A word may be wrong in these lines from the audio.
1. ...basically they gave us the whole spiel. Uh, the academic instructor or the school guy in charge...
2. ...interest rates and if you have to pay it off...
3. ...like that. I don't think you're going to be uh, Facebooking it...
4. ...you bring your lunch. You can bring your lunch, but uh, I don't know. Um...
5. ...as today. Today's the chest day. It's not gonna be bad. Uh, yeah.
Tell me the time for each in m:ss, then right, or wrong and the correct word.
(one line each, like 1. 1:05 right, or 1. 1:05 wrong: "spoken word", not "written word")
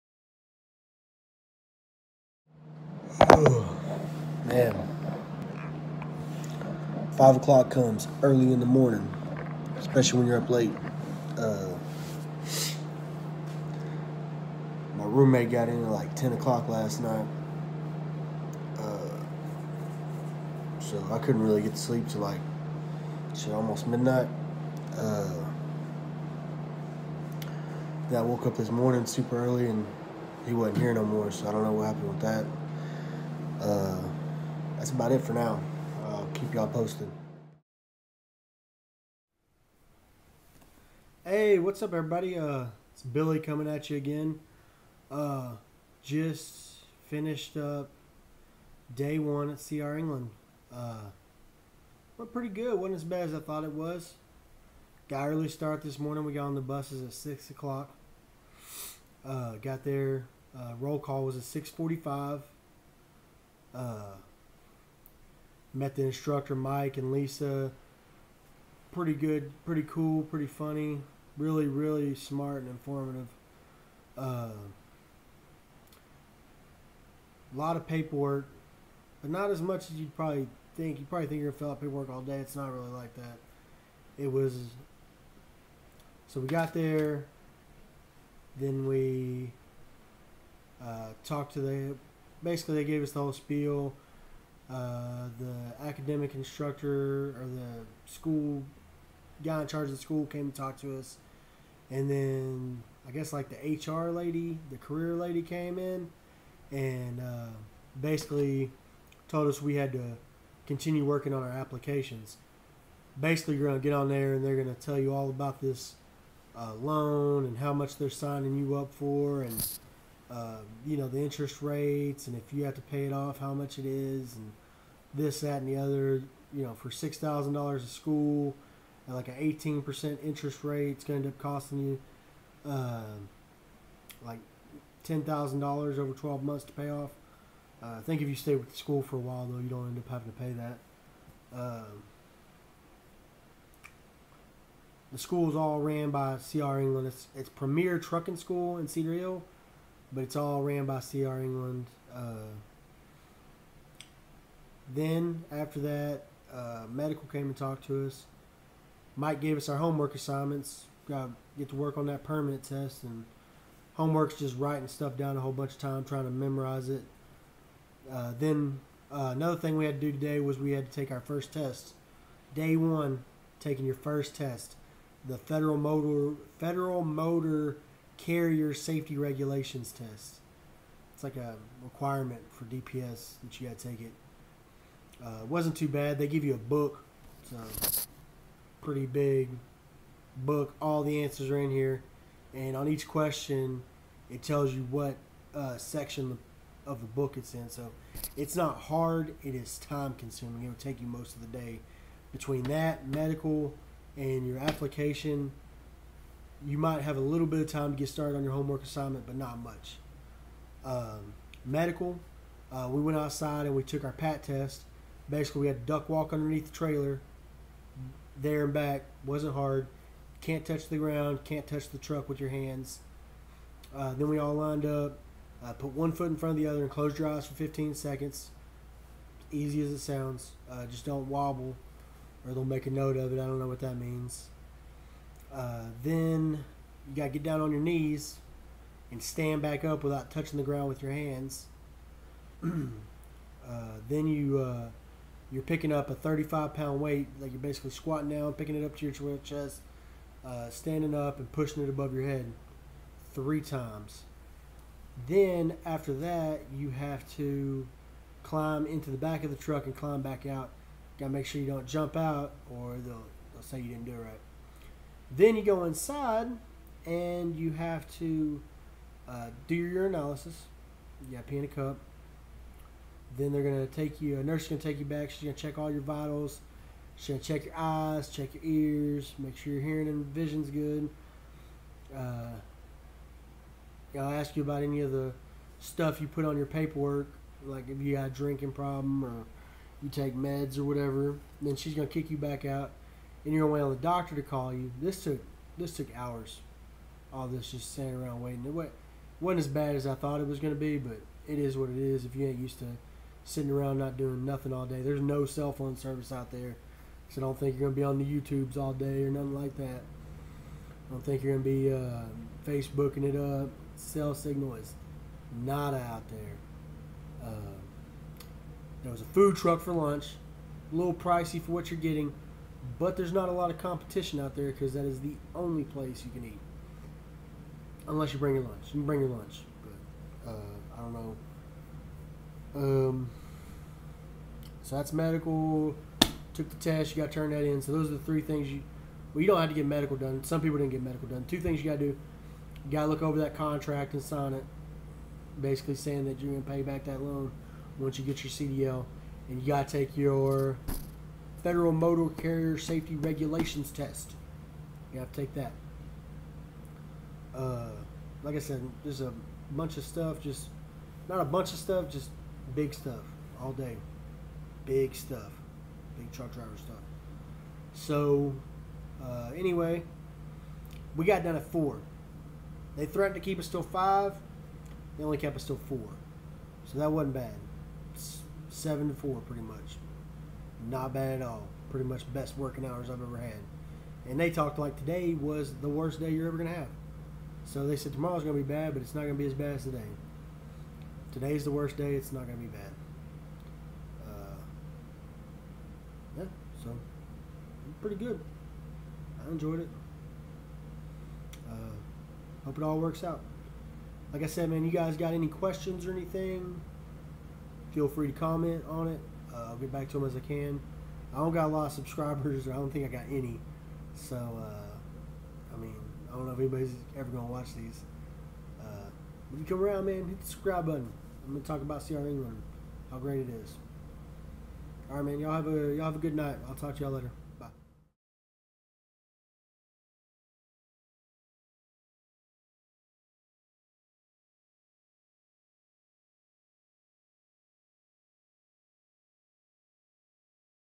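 1. 1:32 right
2. 2:01 right
3. 5:09 right
4. 5:28 right
5. 6:29 wrong: "worst", not "chest".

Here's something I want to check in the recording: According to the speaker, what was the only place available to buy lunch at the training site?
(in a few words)
a food truck.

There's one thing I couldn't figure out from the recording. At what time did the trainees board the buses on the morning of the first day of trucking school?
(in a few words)
6:00.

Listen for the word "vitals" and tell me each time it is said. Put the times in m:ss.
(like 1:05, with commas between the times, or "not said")
4:36.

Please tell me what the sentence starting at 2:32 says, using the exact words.
Uh, then after that, uh, medical came and talked to us.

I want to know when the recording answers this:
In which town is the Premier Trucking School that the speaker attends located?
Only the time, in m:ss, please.
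2:28.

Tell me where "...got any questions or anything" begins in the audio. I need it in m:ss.
6:45.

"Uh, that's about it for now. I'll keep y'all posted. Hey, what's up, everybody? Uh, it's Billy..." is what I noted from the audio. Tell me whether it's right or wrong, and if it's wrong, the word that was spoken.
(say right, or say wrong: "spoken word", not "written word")
right.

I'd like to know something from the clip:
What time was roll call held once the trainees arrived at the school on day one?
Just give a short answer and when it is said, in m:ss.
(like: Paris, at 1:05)
6:45, at 1:01.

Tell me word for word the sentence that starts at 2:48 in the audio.
Uh, then uh, another thing we had to do today was we had to take our first test.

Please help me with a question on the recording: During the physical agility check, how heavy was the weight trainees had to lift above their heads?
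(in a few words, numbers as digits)
35 pounds.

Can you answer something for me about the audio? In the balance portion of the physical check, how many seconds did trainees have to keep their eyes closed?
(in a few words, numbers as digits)
15.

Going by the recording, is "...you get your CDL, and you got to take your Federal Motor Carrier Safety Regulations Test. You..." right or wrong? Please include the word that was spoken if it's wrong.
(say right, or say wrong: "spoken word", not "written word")
right.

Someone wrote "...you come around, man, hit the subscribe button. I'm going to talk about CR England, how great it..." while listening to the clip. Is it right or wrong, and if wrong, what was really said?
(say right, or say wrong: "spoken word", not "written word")
right.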